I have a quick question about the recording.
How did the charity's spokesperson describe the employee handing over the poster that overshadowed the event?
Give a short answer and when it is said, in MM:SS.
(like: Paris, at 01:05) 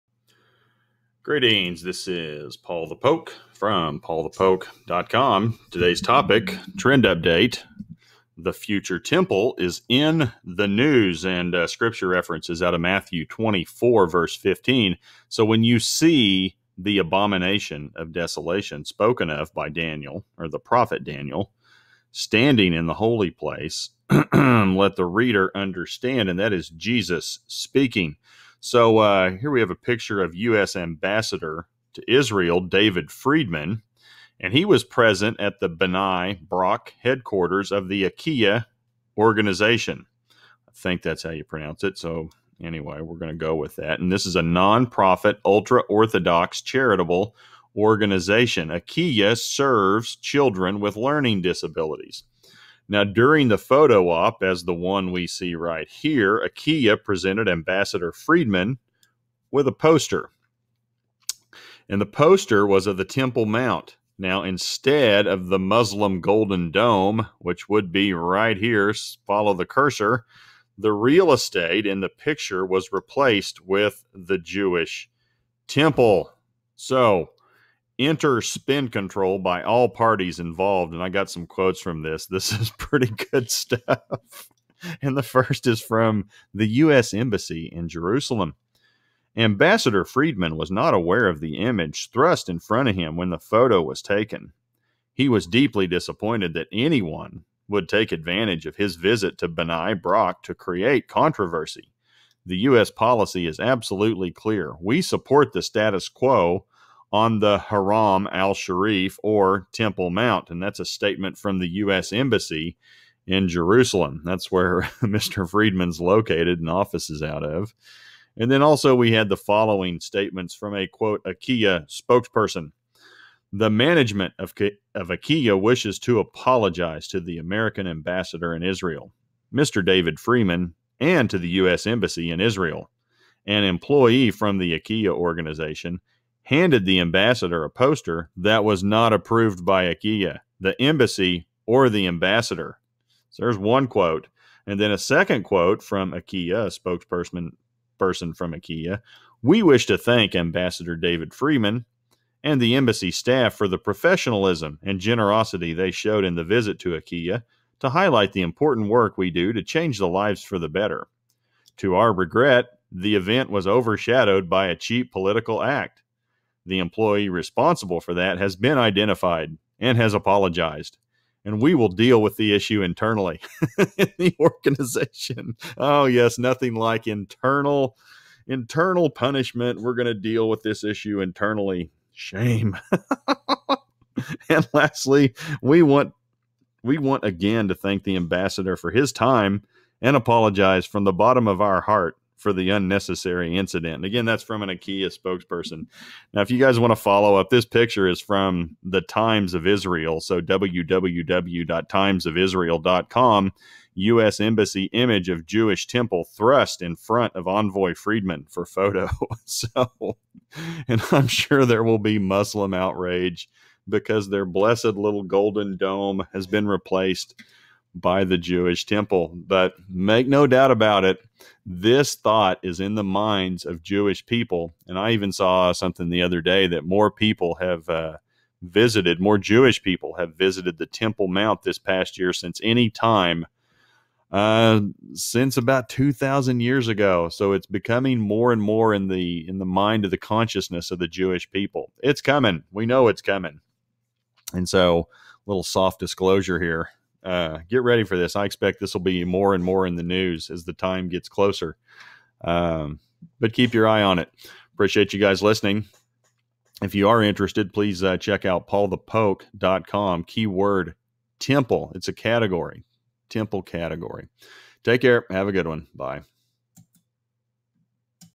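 A cheap political act, at 02:44.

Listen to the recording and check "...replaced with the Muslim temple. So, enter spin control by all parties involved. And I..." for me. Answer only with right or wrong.
wrong.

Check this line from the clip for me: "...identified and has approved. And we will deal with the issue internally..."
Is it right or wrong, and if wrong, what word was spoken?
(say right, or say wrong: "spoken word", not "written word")
wrong: "apologized", not "approved".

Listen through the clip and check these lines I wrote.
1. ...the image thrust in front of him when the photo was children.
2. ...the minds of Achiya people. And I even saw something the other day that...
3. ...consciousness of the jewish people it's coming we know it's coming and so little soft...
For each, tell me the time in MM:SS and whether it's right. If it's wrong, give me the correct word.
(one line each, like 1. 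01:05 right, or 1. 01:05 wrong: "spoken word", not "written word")
1. 01:31 wrong: "taken", not "children"
2. 03:42 wrong: "Jewish", not "Achiya"
3. 04:00 right.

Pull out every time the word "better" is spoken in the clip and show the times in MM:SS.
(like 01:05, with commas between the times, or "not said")
02:40.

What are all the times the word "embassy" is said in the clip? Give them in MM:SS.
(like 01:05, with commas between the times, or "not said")
01:27, 01:52, 02:11, 02:20, 02:32, 03:24.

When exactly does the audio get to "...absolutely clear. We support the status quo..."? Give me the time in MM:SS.
01:43.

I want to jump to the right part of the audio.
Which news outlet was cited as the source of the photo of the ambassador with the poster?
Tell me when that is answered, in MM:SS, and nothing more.
03:19.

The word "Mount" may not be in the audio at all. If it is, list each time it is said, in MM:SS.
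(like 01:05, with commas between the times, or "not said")
01:03, 01:50, 03:51.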